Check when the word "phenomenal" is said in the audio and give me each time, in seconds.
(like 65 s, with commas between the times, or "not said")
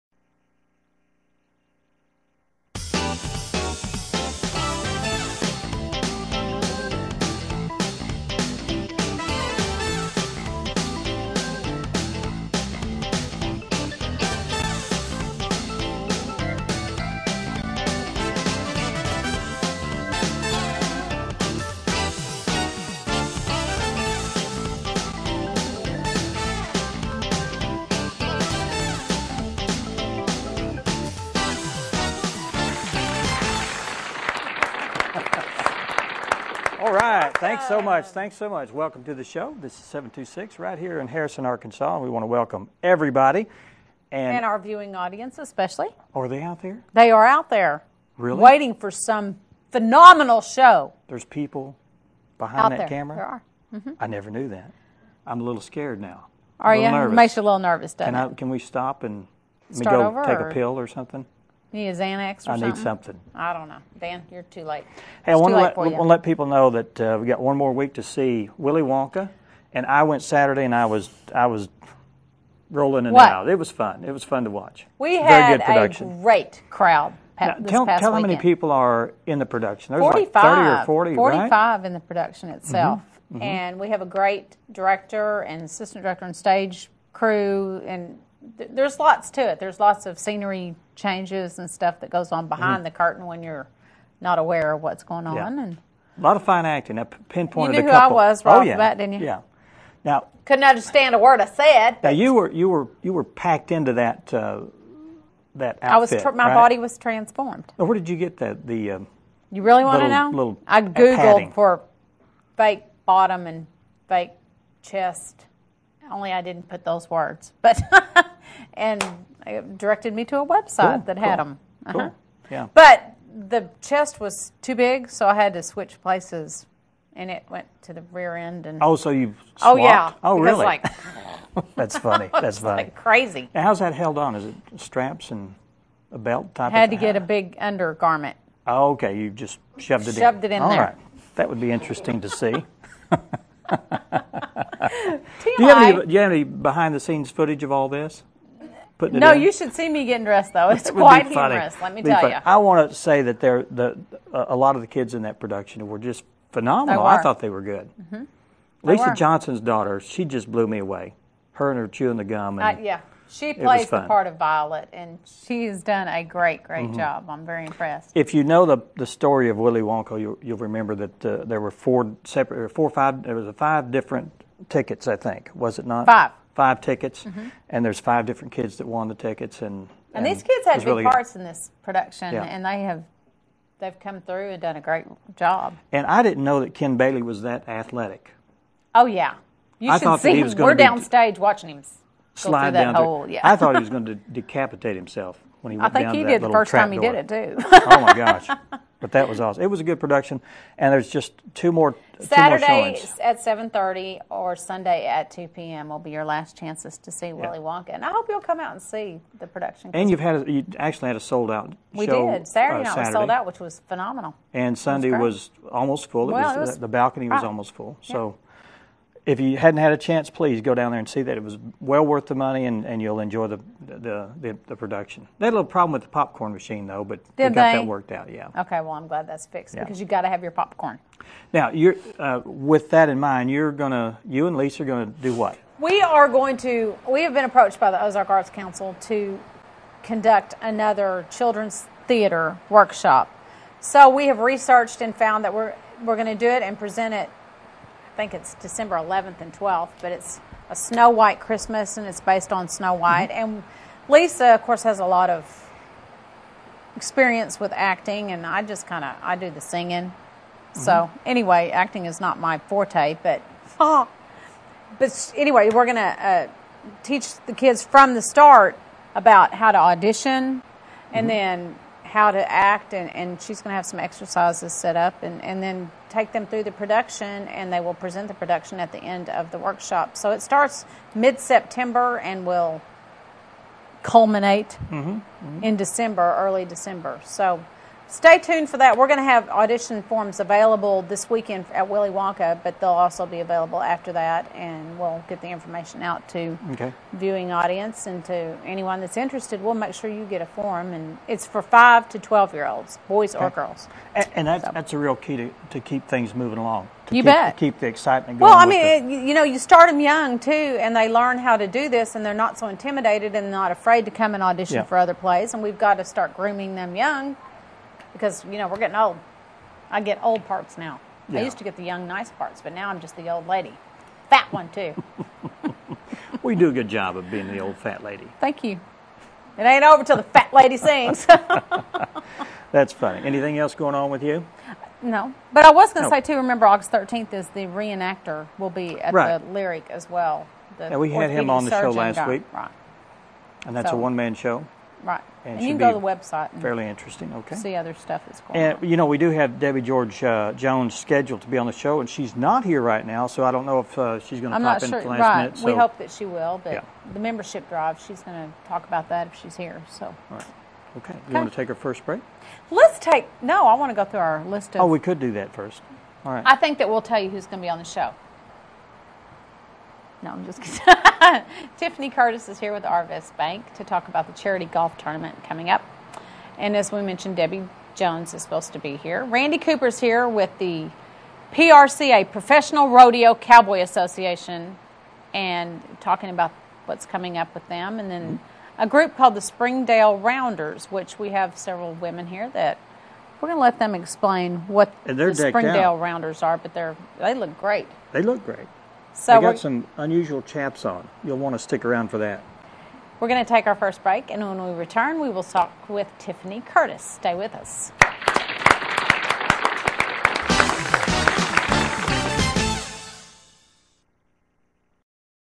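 49 s, 156 s, 213 s.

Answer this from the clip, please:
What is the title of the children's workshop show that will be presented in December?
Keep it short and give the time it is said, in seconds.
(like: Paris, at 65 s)
A Snow White Christmas, at 250 s.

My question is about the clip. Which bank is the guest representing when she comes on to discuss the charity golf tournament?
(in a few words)
Arvest Bank.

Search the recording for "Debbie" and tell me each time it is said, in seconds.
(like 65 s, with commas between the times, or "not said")
349 s, 377 s.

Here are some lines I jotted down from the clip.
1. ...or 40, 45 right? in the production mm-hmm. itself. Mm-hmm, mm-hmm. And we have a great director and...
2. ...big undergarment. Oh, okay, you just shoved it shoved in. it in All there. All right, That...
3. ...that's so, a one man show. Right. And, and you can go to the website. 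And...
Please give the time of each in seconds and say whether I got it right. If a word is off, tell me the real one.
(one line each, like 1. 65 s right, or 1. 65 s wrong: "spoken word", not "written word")
1. 80 s right
2. 137 s right
3. 343 s right.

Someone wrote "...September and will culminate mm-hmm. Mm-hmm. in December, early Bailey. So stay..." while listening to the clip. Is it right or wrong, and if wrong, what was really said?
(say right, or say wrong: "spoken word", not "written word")
wrong: "December", not "Bailey".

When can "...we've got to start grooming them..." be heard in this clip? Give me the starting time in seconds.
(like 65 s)
315 s.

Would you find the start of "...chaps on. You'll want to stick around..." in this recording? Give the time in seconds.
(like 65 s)
400 s.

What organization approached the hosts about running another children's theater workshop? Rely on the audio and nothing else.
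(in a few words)
Ozark Arts Council.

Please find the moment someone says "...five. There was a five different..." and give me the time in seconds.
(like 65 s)
172 s.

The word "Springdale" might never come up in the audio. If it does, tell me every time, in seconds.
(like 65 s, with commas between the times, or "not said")
389 s, 395 s.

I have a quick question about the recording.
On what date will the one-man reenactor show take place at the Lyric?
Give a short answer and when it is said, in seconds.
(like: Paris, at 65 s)
August 13, at 336 s.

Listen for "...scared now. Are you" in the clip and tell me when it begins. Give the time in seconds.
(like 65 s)
55 s.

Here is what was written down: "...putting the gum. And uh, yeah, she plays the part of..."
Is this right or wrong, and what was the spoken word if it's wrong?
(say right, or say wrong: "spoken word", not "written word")
wrong: "chewing", not "putting".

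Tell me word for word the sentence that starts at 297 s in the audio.
viewing audience and to anyone that's interested.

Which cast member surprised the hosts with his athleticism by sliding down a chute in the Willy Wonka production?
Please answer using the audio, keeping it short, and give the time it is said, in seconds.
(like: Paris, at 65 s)
Ken Bailey, at 186 s.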